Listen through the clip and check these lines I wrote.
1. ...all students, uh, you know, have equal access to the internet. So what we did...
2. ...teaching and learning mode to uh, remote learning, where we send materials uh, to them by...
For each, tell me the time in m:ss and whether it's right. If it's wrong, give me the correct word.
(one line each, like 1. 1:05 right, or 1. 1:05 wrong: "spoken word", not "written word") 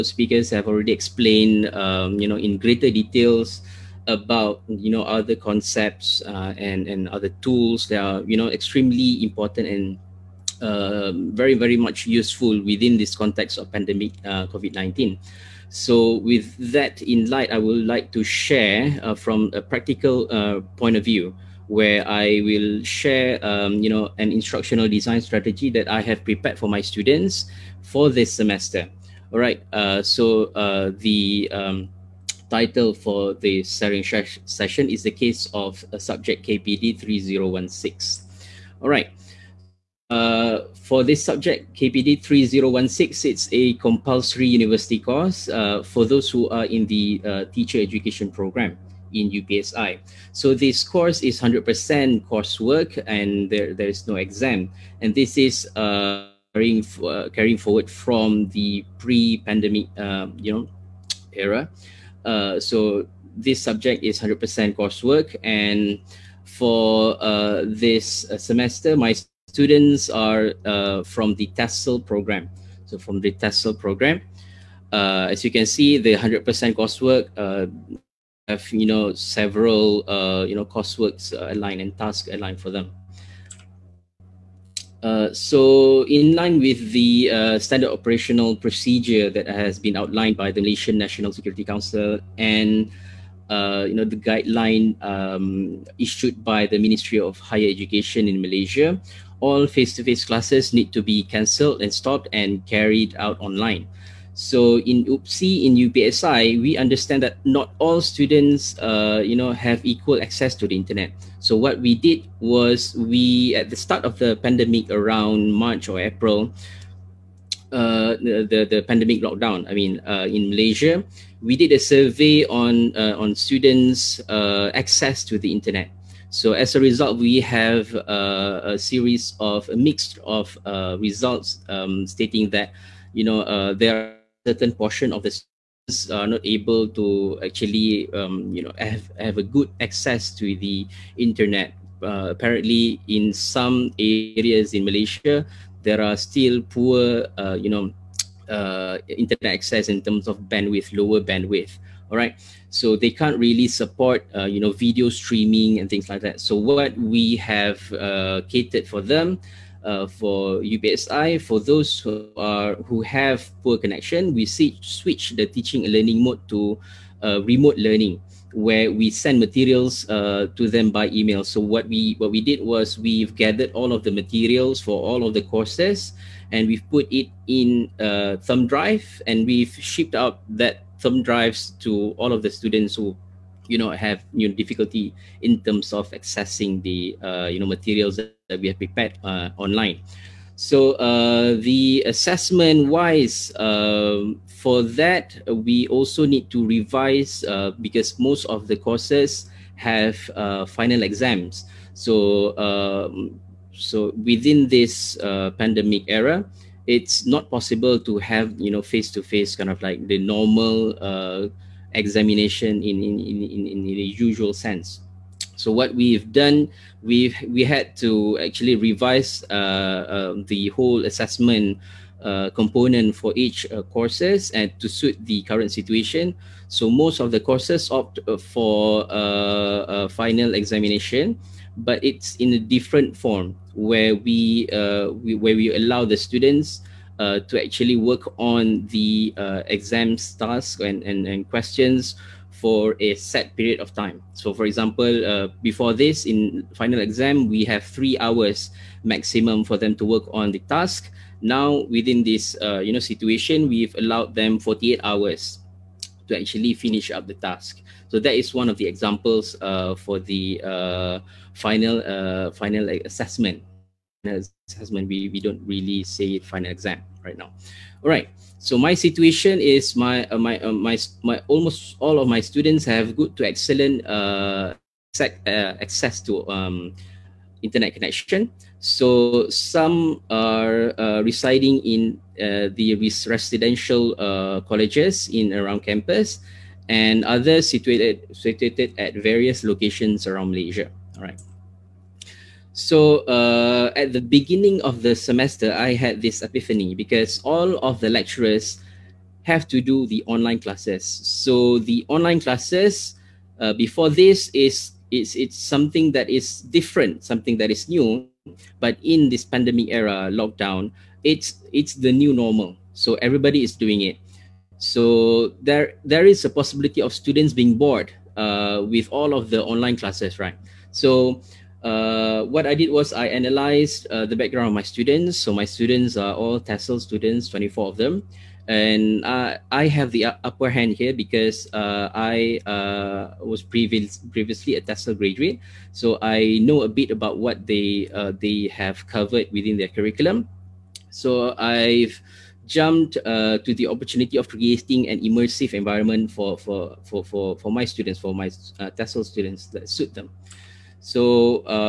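1. 1:47 right
2. 2:45 right.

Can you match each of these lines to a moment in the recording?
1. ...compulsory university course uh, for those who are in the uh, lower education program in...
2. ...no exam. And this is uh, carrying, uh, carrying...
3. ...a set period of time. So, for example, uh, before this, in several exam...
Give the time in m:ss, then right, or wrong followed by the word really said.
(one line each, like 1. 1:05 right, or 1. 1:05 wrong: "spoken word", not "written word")
1. 0:43 wrong: "teacher", not "lower"
2. 0:54 right
3. 4:02 wrong: "final", not "several".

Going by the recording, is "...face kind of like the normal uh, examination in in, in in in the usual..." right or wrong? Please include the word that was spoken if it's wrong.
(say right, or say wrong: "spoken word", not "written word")
right.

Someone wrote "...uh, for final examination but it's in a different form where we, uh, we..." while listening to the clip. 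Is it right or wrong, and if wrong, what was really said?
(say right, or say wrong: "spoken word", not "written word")
right.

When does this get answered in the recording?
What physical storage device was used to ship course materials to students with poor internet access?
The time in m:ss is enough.
2:58.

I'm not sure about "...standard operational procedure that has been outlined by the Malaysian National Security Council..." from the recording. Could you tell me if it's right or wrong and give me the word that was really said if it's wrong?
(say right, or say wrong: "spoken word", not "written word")
right.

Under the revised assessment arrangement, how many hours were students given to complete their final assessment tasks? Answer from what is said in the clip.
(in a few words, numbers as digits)
48 hours.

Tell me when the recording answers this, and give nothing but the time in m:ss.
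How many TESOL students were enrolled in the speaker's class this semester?
5:27.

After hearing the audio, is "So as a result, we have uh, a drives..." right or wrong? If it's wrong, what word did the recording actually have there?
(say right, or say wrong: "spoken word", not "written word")
wrong: "series", not "drives".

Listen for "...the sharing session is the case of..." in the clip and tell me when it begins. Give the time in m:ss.
0:33.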